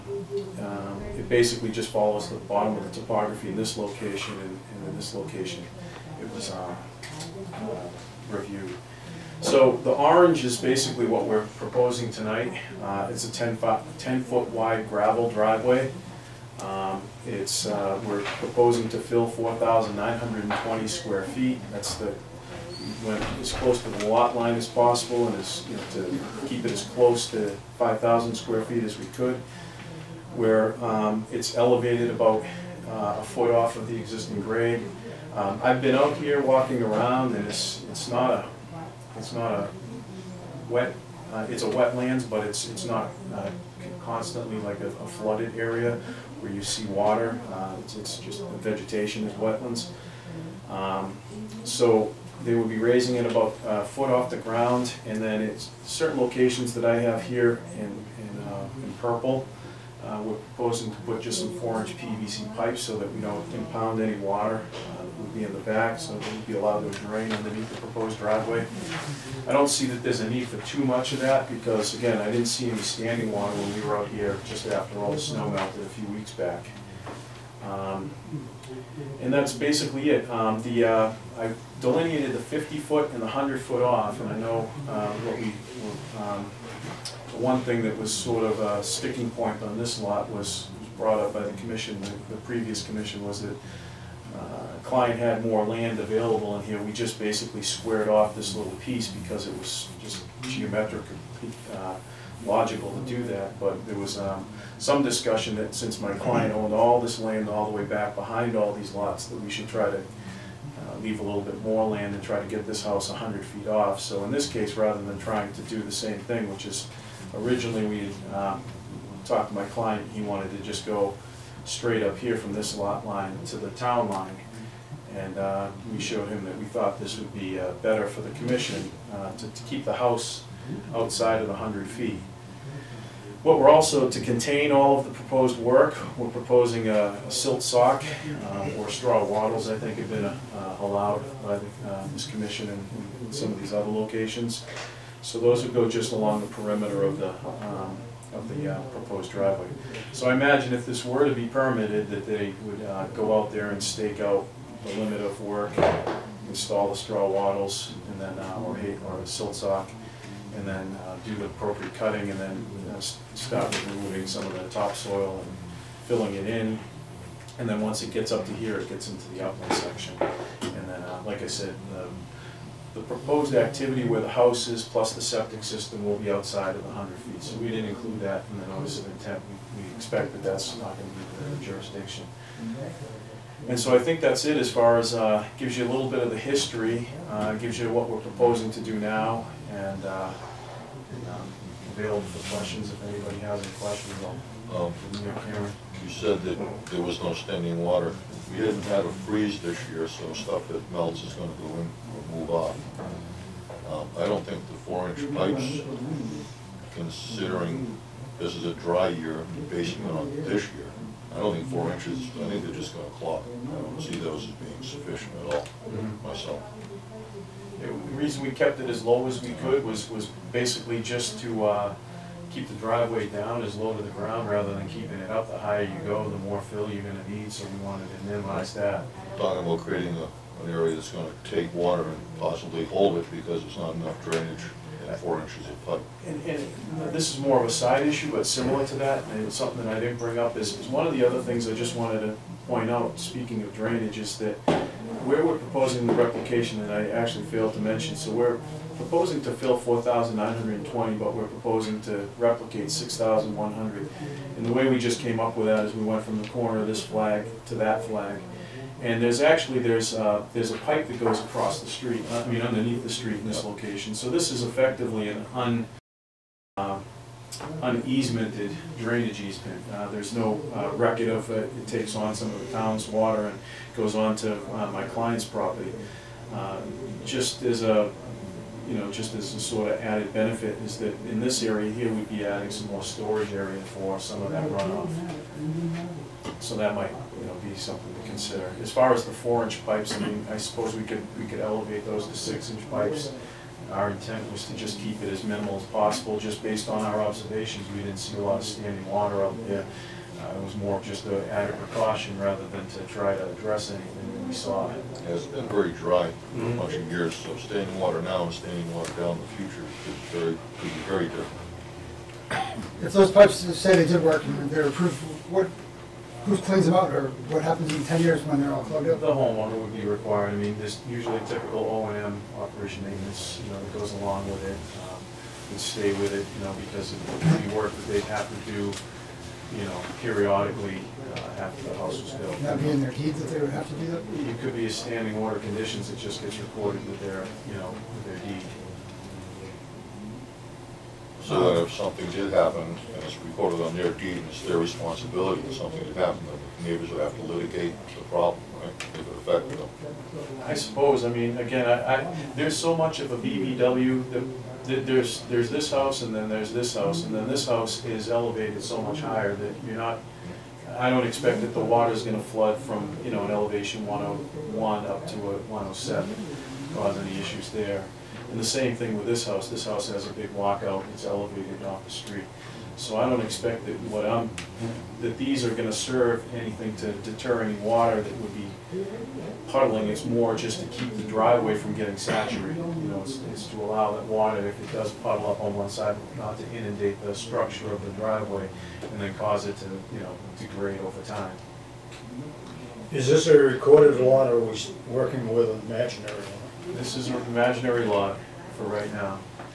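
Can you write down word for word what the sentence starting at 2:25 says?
So those would go just along the perimeter of the, um, of the uh, proposed driveway.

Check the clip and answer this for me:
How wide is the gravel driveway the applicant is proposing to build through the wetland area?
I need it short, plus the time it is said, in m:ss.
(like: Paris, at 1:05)
10 feet, at 0:13.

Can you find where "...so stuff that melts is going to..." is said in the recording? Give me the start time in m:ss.
3:20.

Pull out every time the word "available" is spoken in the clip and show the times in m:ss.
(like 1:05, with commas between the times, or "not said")
1:35, 3:11.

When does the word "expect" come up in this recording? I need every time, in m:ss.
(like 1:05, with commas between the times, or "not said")
2:59, 6:01, 6:13.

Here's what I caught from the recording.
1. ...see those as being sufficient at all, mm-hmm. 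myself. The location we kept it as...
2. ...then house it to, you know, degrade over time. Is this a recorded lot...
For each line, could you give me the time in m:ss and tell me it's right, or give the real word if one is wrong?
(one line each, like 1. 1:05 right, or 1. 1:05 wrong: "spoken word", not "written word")
1. 3:34 wrong: "reason", not "location"
2. 6:29 wrong: "cause", not "house".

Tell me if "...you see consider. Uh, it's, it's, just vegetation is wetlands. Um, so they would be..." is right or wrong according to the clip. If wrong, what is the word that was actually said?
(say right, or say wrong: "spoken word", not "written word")
wrong: "water", not "consider".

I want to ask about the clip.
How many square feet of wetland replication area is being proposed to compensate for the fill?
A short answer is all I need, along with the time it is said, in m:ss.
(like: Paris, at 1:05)
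6,100, at 4:12.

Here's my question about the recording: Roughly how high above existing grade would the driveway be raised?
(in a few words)
about a foot.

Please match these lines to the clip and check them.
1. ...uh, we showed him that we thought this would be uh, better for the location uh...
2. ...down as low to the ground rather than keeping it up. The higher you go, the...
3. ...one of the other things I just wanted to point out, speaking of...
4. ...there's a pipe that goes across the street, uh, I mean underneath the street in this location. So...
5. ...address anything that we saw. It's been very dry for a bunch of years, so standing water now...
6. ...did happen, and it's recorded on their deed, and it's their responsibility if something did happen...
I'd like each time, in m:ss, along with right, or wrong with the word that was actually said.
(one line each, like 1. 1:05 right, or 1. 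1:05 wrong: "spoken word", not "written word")
1. 2:05 wrong: "commission", not "location"
2. 3:43 right
3. 4:00 right
4. 4:20 right
5. 5:03 right
6. 5:42 right.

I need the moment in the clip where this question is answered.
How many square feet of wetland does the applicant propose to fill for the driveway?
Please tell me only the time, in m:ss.
0:19.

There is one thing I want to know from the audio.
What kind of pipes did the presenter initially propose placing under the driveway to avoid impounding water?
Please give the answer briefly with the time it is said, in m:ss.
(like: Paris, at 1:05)
4-inch PVC pipes, at 1:01.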